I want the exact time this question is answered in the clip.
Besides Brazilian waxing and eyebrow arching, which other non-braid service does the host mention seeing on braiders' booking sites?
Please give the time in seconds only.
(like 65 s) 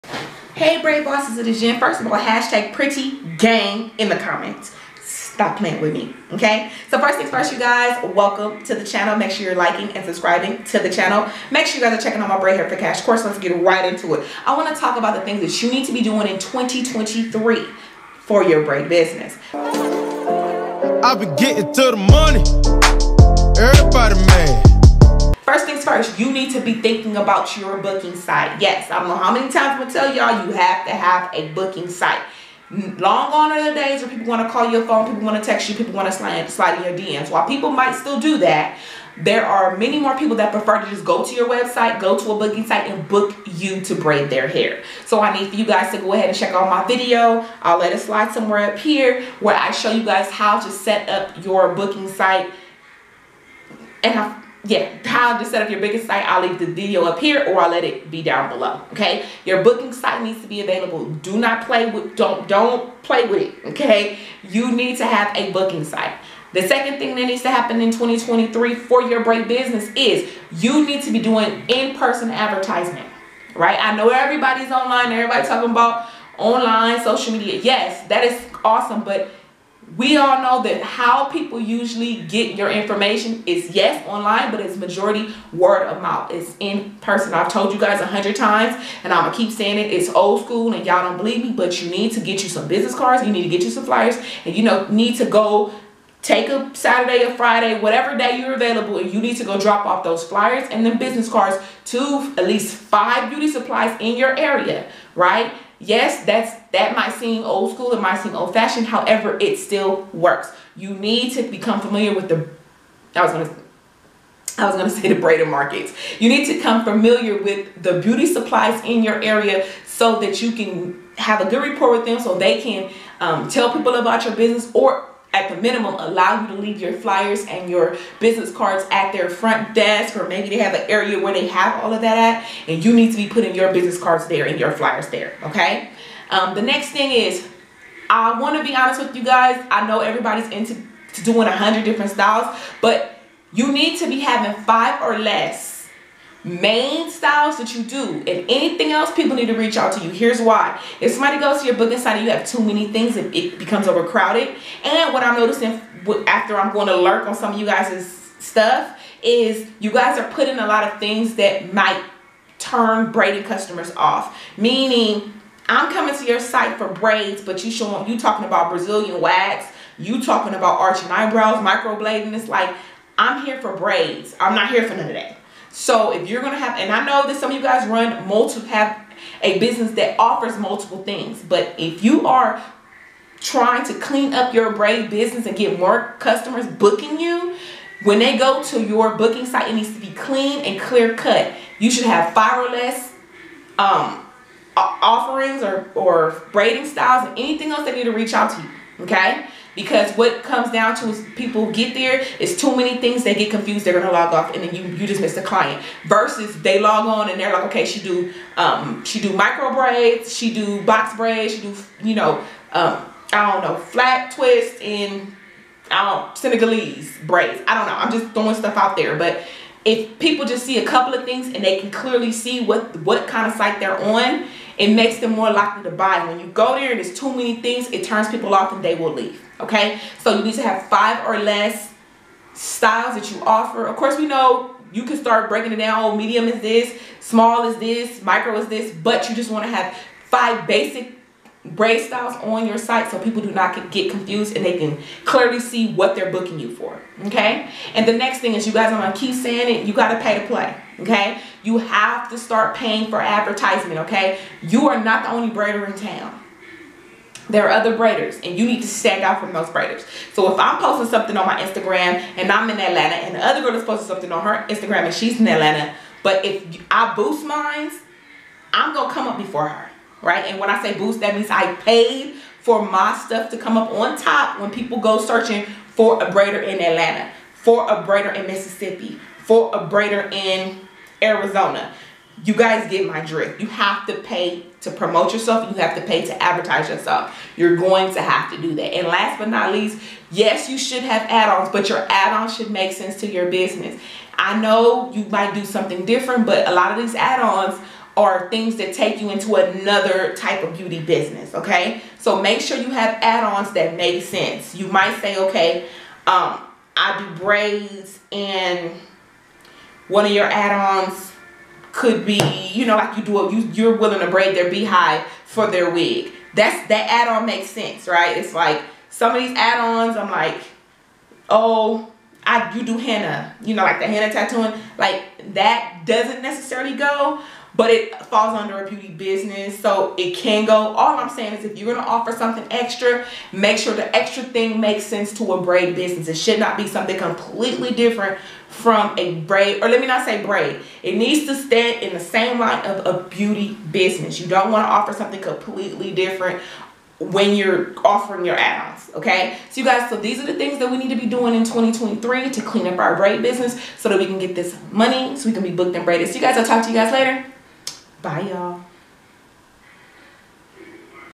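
171 s.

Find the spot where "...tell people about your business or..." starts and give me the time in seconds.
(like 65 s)
123 s.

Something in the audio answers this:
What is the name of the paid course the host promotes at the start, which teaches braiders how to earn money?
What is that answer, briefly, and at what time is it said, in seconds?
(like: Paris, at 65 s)
Braid Hair for Cash, at 12 s.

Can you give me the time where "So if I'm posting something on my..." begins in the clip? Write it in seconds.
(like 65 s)
260 s.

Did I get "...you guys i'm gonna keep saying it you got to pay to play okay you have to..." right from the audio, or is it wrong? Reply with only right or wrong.
right.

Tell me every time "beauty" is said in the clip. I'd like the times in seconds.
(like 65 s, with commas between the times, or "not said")
103 s, 117 s, 300 s, 328 s, 343 s.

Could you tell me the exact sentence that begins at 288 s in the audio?
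And last but not least, yes, you should have add-ons, but your add-ons should make sense to your business.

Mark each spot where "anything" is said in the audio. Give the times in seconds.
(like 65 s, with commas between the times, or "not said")
148 s, 197 s.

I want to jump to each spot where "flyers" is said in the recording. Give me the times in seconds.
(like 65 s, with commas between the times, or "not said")
93 s, 100 s, 126 s, 134 s.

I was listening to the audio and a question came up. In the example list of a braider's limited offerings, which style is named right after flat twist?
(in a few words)
Senegalese braids.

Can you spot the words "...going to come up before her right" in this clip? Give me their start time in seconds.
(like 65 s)
268 s.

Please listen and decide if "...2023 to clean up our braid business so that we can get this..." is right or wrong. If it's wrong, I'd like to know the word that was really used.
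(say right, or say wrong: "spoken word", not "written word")
right.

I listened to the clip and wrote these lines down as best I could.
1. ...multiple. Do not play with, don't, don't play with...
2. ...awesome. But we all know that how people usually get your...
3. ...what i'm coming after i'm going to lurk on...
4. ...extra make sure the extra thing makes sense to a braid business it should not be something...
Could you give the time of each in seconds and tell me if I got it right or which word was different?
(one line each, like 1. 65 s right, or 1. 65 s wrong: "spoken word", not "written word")
1. 60 s wrong: "available", not "multiple"
2. 78 s right
3. 155 s wrong: "noticing", not "coming"
4. 332 s right.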